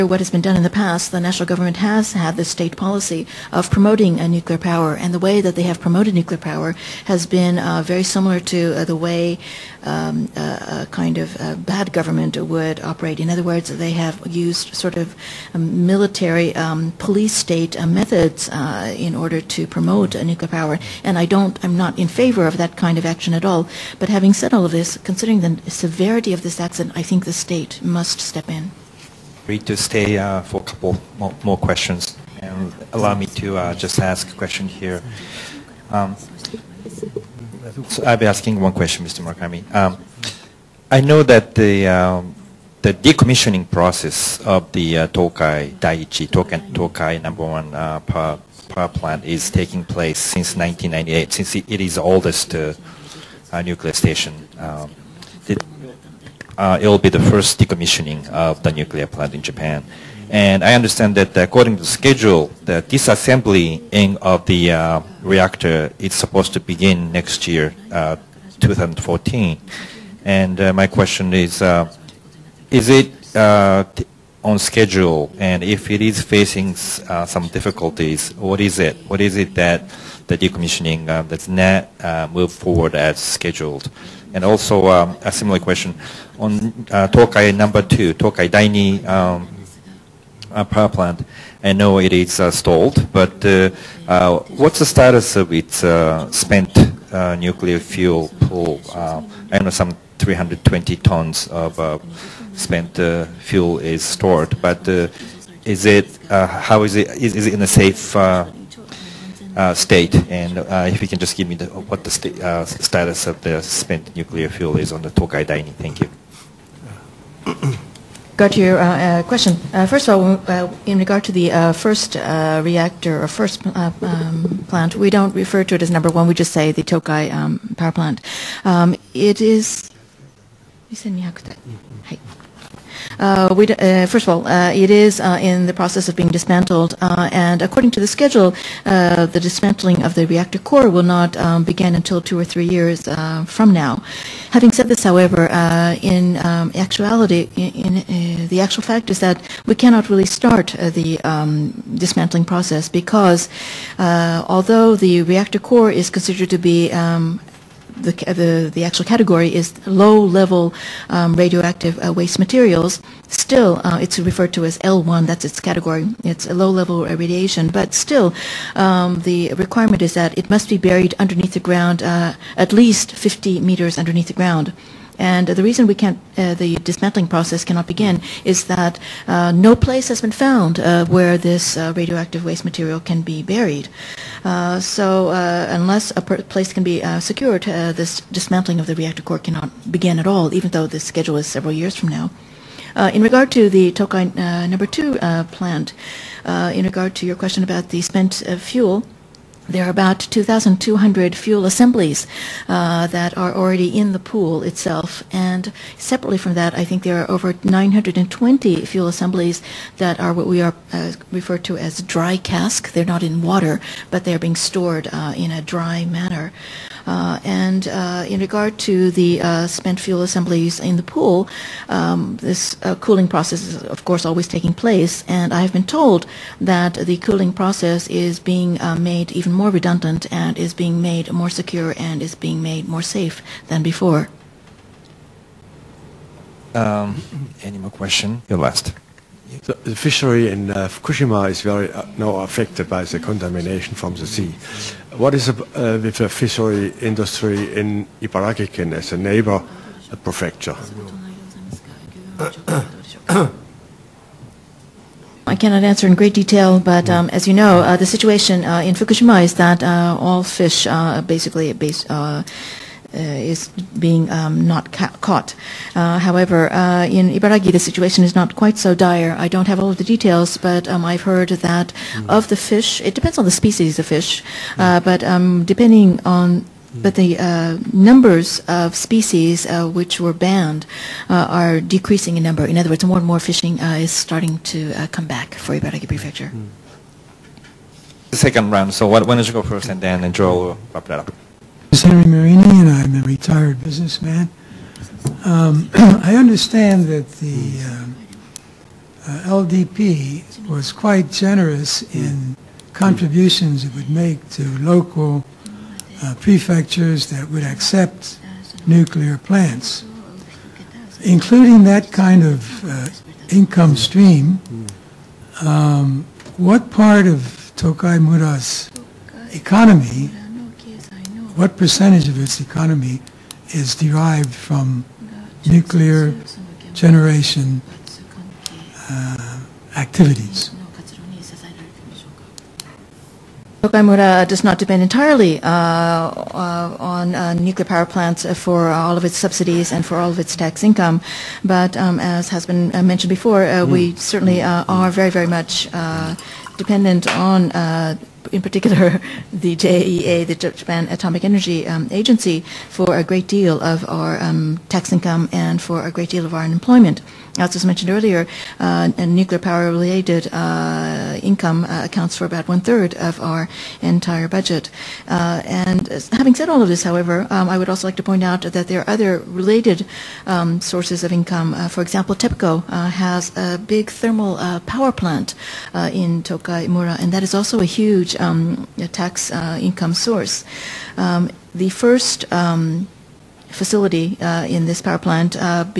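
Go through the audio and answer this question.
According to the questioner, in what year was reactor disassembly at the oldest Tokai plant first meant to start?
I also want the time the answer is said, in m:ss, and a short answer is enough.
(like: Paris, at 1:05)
2014, at 1:08.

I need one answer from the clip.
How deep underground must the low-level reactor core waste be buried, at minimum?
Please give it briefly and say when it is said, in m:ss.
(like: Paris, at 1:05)
50 meters, at 2:53.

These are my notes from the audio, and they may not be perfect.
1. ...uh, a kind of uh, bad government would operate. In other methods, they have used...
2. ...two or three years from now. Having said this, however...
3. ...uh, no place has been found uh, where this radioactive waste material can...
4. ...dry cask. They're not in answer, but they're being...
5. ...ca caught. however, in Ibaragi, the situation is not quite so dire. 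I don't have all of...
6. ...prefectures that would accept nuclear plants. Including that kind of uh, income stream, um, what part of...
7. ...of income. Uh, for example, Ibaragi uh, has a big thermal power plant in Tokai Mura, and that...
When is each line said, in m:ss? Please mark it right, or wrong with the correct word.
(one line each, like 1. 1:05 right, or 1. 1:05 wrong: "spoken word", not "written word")
1. 0:10 wrong: "words", not "methods"
2. 2:22 right
3. 2:59 right
4. 3:32 wrong: "water", not "answer"
5. 4:24 right
6. 5:06 right
7. 6:11 wrong: "TEPCO", not "Ibaragi".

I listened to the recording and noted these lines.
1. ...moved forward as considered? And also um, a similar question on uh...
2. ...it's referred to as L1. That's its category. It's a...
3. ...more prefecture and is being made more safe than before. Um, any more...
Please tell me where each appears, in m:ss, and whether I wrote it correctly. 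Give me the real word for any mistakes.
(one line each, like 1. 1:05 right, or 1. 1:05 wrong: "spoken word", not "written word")
1. 1:22 wrong: "scheduled", not "considered"
2. 2:44 right
3. 3:51 wrong: "secure", not "prefecture".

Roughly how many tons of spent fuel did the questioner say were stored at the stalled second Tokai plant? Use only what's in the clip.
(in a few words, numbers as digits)
320 tons.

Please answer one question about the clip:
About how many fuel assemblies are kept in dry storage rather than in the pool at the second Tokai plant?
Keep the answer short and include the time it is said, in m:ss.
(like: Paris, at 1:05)
920, at 3:27.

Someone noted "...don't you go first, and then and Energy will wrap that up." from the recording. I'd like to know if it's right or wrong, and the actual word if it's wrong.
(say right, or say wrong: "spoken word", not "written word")
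wrong: "Joel", not "Energy".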